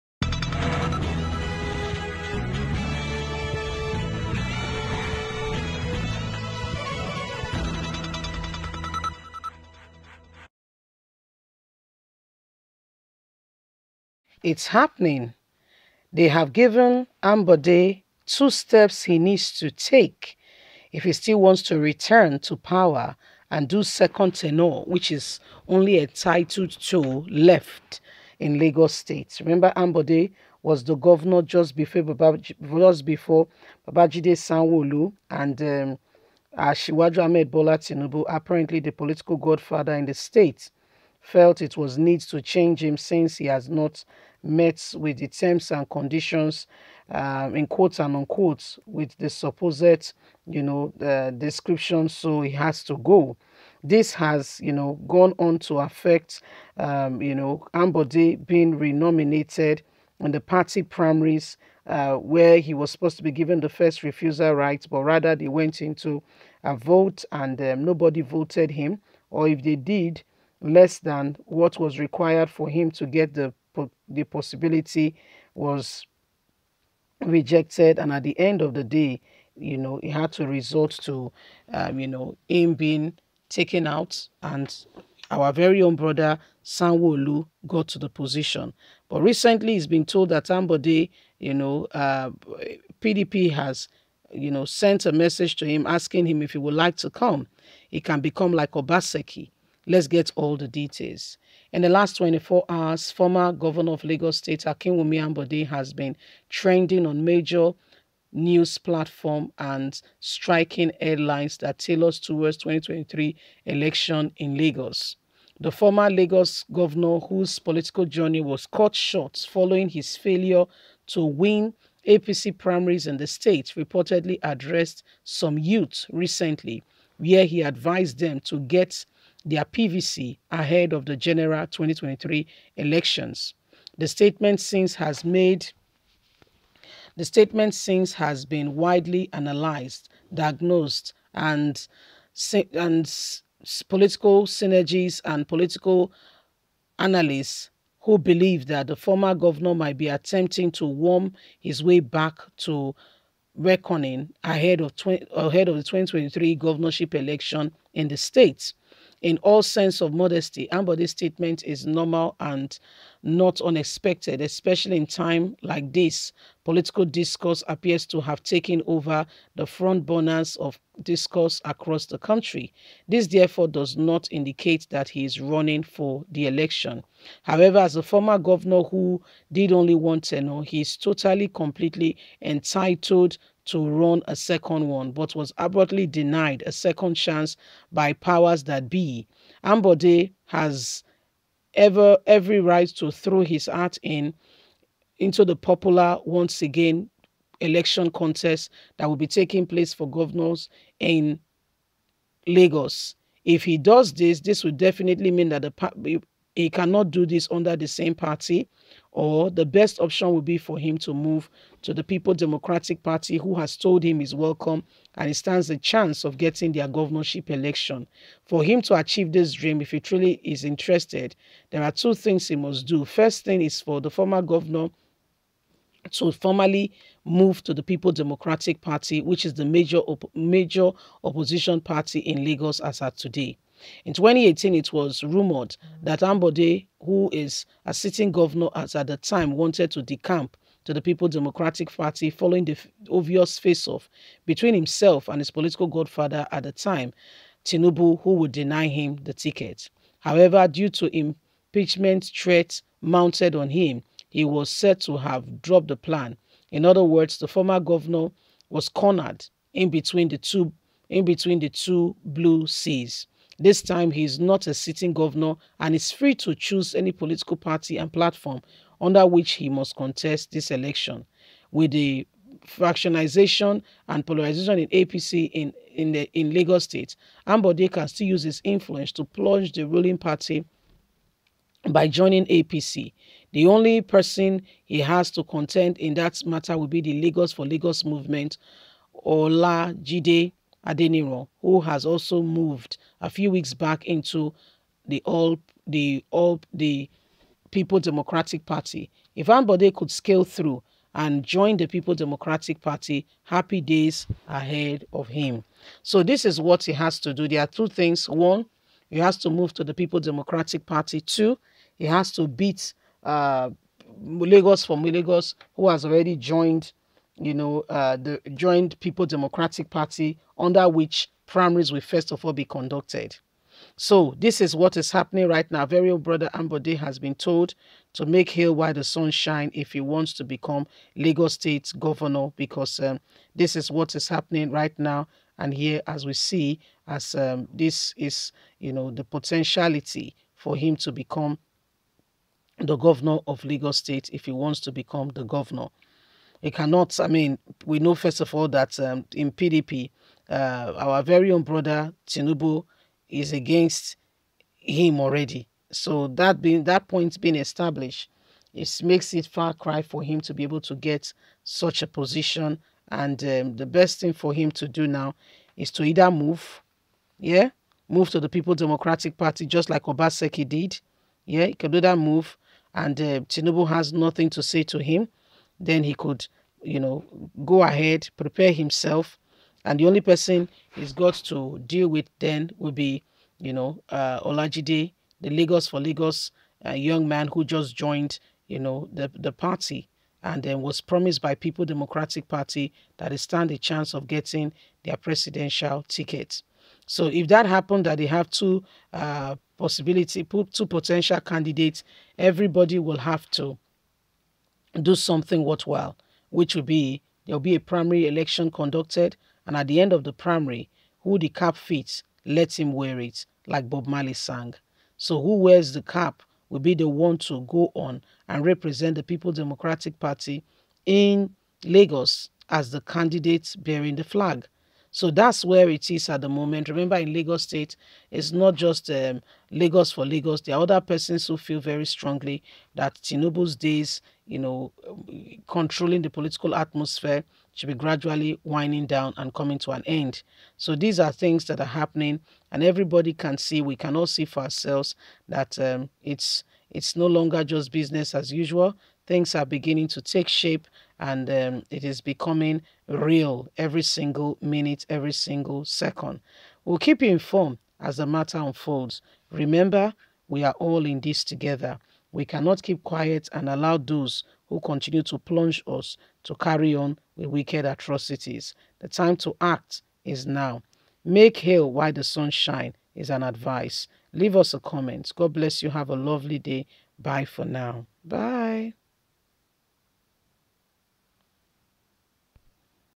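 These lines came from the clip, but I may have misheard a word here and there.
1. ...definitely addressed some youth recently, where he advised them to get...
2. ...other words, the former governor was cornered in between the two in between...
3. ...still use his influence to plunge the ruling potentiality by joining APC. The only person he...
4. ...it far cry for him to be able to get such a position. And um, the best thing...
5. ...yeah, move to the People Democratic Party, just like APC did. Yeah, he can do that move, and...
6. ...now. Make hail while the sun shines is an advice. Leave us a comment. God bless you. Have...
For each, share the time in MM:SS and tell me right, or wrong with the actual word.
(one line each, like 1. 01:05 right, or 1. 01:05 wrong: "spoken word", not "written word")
1. 02:03 wrong: "reportedly", not "definitely"
2. 04:16 right
3. 04:38 wrong: "party", not "potentiality"
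4. 05:59 right
5. 06:07 wrong: "Obaseki", not "APC"
6. 07:50 right.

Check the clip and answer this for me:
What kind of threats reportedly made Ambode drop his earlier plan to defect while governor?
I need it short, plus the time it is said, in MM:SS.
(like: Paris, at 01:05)
impeachment threats, at 04:11.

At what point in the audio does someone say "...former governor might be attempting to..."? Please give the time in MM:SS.
02:28.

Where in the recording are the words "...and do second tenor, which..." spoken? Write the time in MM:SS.
00:23.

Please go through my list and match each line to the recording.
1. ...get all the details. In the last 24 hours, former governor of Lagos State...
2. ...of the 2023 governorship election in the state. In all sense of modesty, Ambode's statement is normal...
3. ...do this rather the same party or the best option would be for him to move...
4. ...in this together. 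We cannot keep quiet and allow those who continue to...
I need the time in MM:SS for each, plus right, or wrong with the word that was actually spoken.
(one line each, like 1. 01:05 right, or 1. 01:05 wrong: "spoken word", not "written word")
1. 01:40 right
2. 02:35 right
3. 03:27 wrong: "under", not "rather"
4. 07:41 right.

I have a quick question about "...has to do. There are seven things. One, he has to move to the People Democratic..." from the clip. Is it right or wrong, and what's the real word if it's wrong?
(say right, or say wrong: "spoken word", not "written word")
wrong: "two", not "seven".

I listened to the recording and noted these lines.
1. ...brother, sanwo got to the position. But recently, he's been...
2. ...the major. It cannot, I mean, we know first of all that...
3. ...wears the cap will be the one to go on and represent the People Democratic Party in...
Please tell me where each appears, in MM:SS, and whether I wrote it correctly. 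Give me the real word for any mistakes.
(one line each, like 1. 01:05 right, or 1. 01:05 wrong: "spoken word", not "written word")
1. 01:25 right
2. 05:45 wrong: "governor", not "major"
3. 06:55 right.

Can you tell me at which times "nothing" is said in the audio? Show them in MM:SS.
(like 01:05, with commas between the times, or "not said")
06:14.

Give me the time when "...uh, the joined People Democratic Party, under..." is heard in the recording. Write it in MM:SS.
05:17.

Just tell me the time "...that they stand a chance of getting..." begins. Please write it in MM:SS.
06:33.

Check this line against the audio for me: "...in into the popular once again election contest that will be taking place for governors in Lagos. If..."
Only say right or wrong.
right.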